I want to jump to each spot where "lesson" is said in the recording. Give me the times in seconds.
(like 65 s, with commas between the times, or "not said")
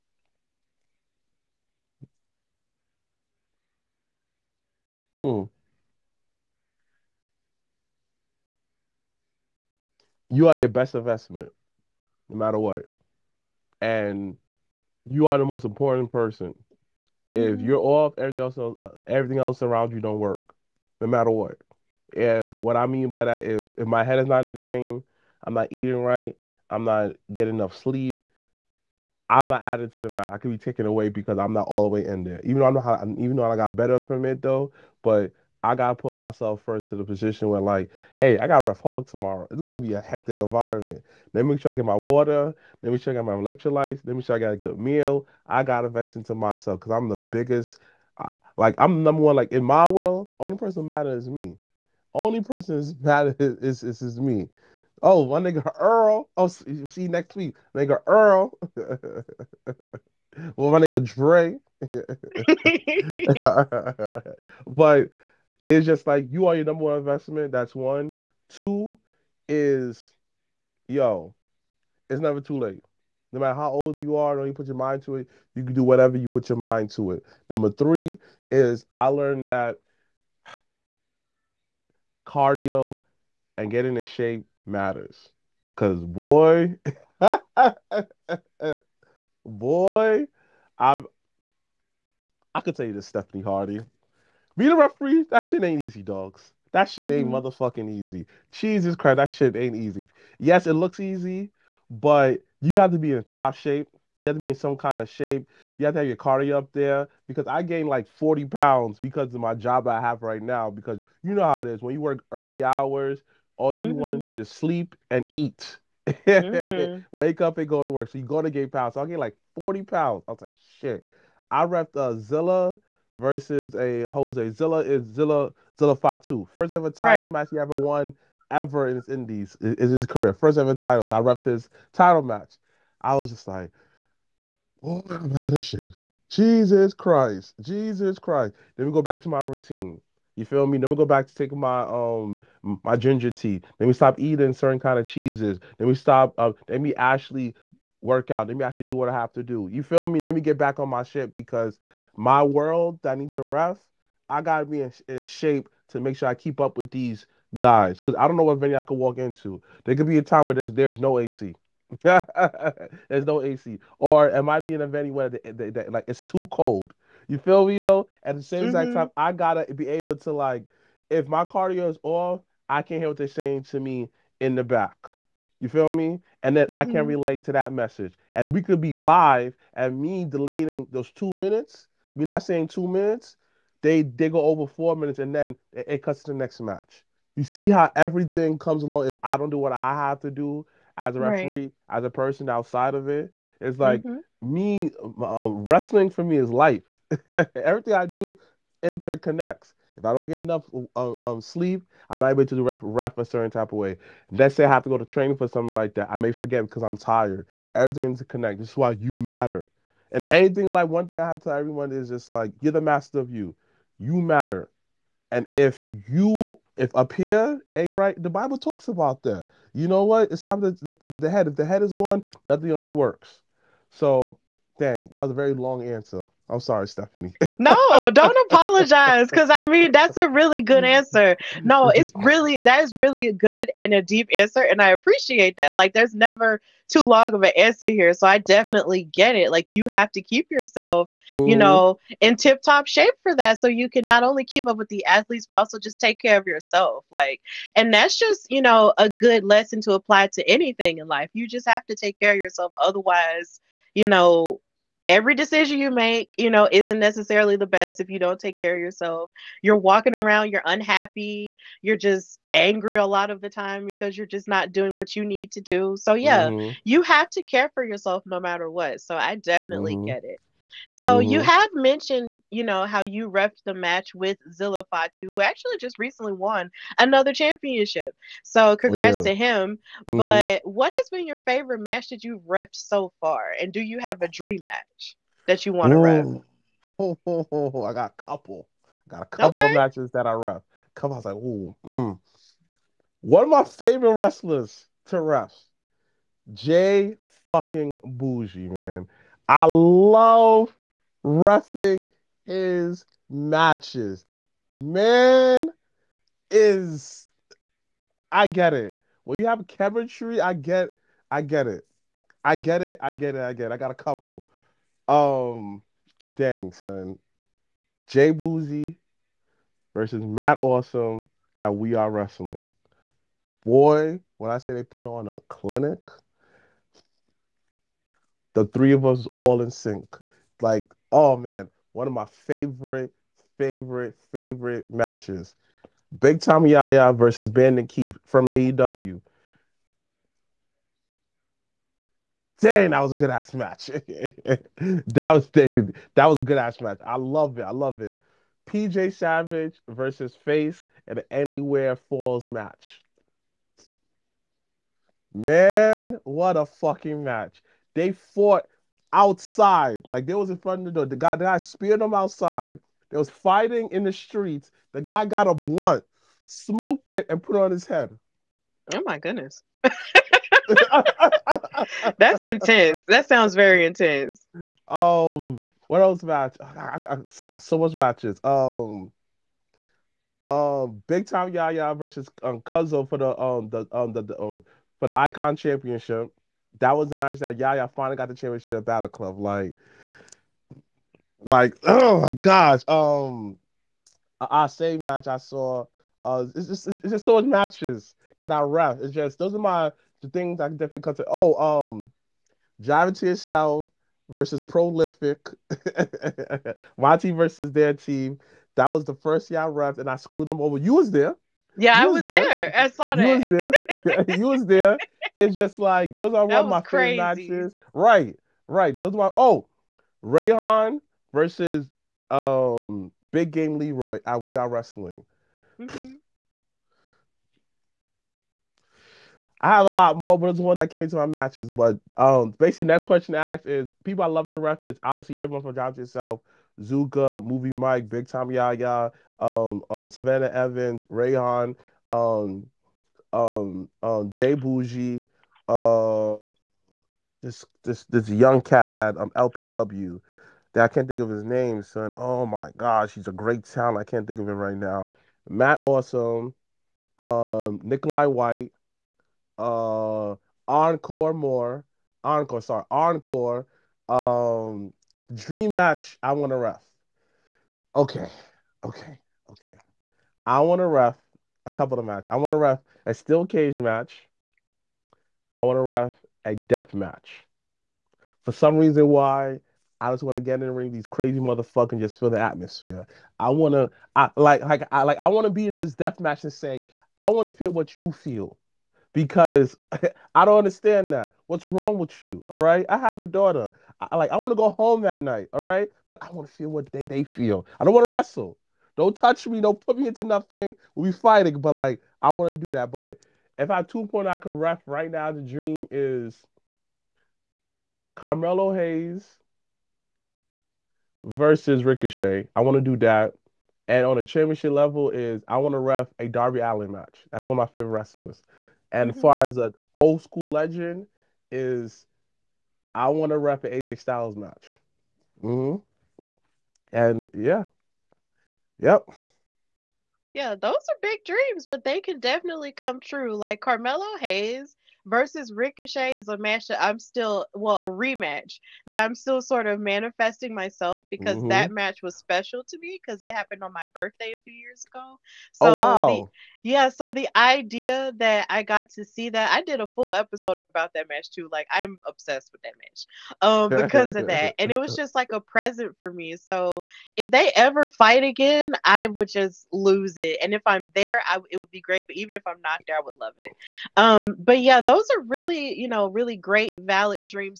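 249 s.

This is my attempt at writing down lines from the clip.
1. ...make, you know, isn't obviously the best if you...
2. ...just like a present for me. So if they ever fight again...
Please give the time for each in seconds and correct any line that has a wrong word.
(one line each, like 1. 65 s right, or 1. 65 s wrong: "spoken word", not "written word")
1. 255 s wrong: "necessarily", not "obviously"
2. 554 s right.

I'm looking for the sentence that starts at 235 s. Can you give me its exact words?
Like, there's never too long of an answer here, so I definitely get it.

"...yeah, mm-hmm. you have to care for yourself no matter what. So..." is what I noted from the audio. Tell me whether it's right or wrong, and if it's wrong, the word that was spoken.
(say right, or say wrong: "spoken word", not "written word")
right.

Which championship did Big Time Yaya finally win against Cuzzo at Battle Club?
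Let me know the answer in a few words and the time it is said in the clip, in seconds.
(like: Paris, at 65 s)
Icon Championship, at 385 s.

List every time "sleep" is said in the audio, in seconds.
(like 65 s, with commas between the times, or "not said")
27 s, 114 s, 201 s.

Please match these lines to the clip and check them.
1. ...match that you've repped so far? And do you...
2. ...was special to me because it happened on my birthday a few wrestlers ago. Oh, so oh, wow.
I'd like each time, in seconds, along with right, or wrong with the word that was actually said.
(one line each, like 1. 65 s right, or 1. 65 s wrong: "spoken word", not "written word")
1. 281 s right
2. 542 s wrong: "years", not "wrestlers".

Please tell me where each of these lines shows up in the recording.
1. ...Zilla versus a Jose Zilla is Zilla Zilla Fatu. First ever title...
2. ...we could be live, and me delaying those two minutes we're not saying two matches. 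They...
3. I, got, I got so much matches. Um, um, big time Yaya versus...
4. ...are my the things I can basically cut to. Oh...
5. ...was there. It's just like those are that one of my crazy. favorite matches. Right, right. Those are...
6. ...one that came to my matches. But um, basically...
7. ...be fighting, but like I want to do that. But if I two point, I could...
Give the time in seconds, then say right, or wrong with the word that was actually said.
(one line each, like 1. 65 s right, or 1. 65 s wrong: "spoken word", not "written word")
1. 122 s right
2. 178 s wrong: "minutes", not "matches"
3. 376 s right
4. 399 s wrong: "definitely", not "basically"
5. 414 s right
6. 430 s right
7. 501 s right.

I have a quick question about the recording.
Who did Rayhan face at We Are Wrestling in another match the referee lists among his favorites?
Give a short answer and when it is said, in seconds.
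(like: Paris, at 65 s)
Big Game Leroy, at 423 s.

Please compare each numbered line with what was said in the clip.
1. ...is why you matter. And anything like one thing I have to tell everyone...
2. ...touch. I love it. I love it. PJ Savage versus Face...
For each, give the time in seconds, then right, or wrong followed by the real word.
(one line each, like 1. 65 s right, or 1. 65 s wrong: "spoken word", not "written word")
1. 208 s right
2. 346 s wrong: "match", not "touch".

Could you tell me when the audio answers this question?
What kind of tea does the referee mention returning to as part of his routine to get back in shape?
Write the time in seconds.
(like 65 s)
142 s.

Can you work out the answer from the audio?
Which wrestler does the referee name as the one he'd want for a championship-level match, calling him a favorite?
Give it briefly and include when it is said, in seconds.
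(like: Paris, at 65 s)
Darby Allin, at 516 s.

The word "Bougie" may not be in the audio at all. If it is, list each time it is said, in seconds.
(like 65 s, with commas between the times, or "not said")
298 s, 318 s, 444 s.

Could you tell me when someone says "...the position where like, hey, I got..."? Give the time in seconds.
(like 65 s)
36 s.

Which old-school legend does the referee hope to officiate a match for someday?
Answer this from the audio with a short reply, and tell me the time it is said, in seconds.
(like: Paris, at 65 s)
AJ Styles, at 523 s.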